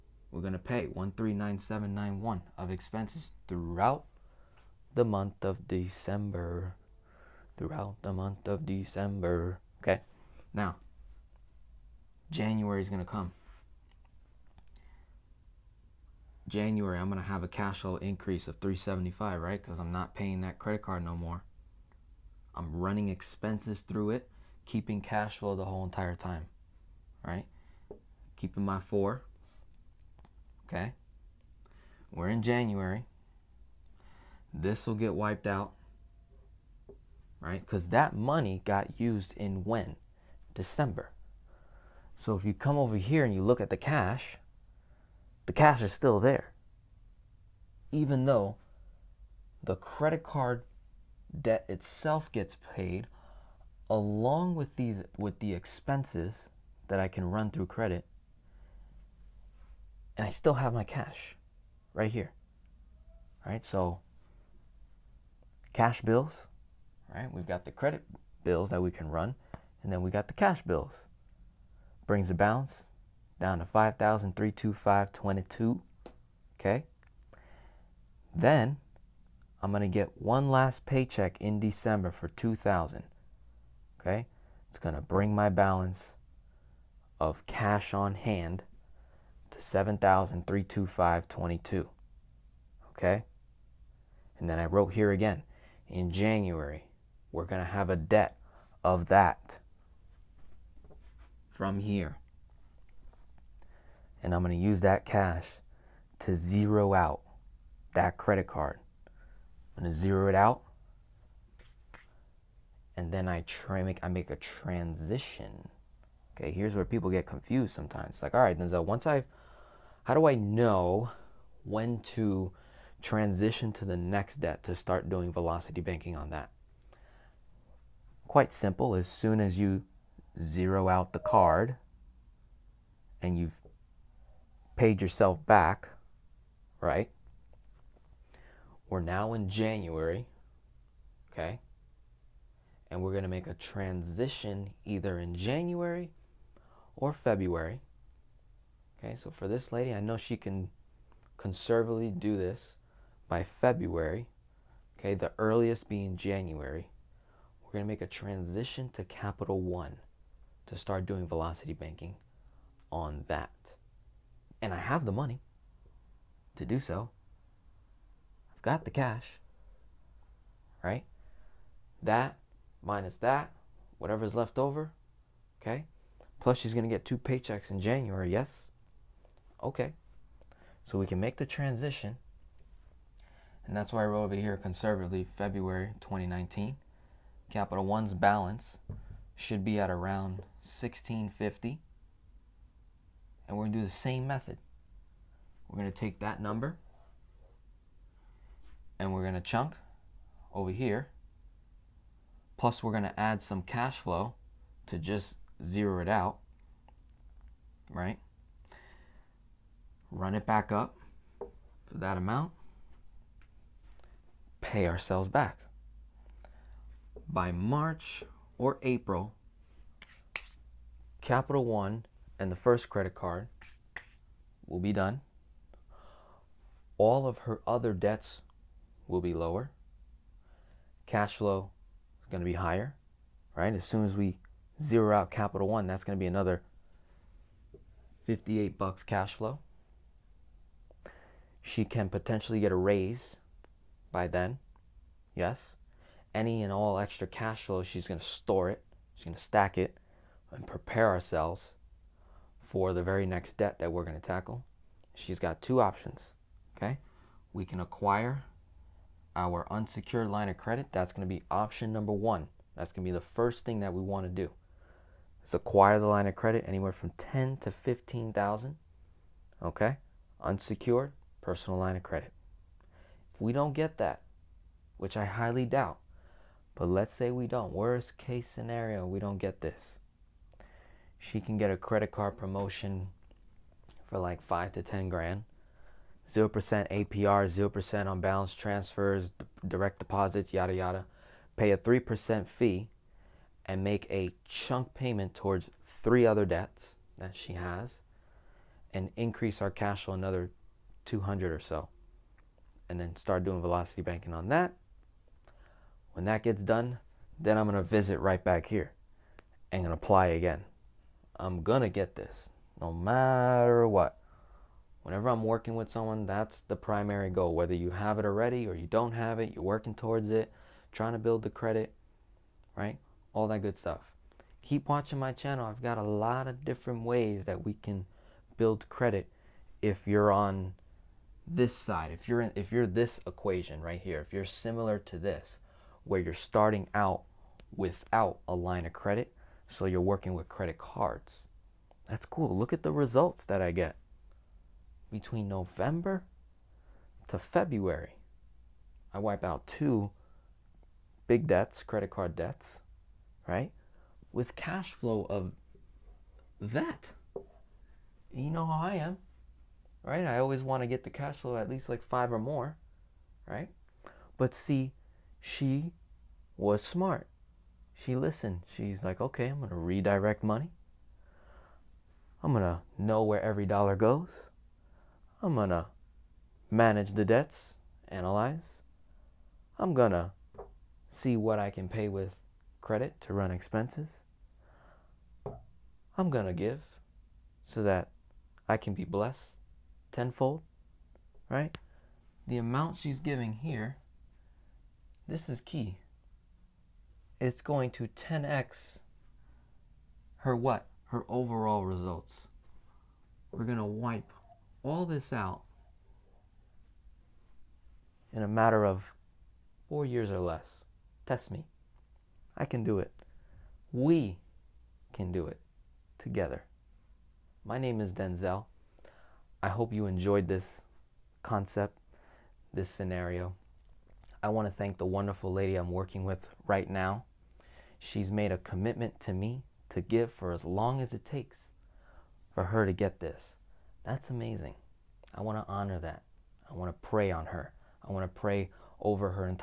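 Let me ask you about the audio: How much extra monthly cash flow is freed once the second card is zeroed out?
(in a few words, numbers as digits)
58.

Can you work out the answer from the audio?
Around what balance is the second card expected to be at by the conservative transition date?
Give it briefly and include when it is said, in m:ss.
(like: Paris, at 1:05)
1650, at 3:10.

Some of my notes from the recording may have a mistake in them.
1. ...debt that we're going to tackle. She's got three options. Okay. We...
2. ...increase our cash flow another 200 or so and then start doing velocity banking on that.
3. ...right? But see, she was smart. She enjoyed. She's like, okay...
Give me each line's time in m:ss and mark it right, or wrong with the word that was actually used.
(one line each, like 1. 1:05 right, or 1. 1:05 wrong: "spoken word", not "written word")
1. 4:13 wrong: "two", not "three"
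2. 4:59 right
3. 6:03 wrong: "listened", not "enjoyed".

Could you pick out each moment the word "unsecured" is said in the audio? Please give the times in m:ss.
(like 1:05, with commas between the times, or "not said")
4:19, 4:30.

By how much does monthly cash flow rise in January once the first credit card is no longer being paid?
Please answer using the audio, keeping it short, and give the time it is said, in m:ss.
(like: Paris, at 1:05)
375, at 0:18.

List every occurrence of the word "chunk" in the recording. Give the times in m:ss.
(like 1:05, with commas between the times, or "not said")
3:19, 4:54.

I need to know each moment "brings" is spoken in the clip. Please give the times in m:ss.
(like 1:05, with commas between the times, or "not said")
1:12, 1:25.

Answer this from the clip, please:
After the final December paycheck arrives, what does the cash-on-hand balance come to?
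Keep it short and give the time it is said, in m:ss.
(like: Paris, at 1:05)
7,325.22, at 1:29.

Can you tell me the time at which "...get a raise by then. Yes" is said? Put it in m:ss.
4:02.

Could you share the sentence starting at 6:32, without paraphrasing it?
The amount she's giving here, this is key.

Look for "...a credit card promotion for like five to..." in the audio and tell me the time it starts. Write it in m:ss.
4:41.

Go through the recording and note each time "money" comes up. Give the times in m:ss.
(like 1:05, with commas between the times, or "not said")
0:38, 2:45, 6:10.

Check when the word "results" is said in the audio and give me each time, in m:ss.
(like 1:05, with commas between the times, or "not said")
5:42, 6:41.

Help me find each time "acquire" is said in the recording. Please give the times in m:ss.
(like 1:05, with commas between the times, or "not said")
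4:17, 4:25.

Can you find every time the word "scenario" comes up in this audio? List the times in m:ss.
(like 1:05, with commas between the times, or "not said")
4:38, 7:02.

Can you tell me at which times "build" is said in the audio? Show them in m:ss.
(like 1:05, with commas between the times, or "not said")
5:21, 5:28.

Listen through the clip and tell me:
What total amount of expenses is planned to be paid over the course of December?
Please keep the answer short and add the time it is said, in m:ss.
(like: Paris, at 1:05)
1,397.91, at 0:00.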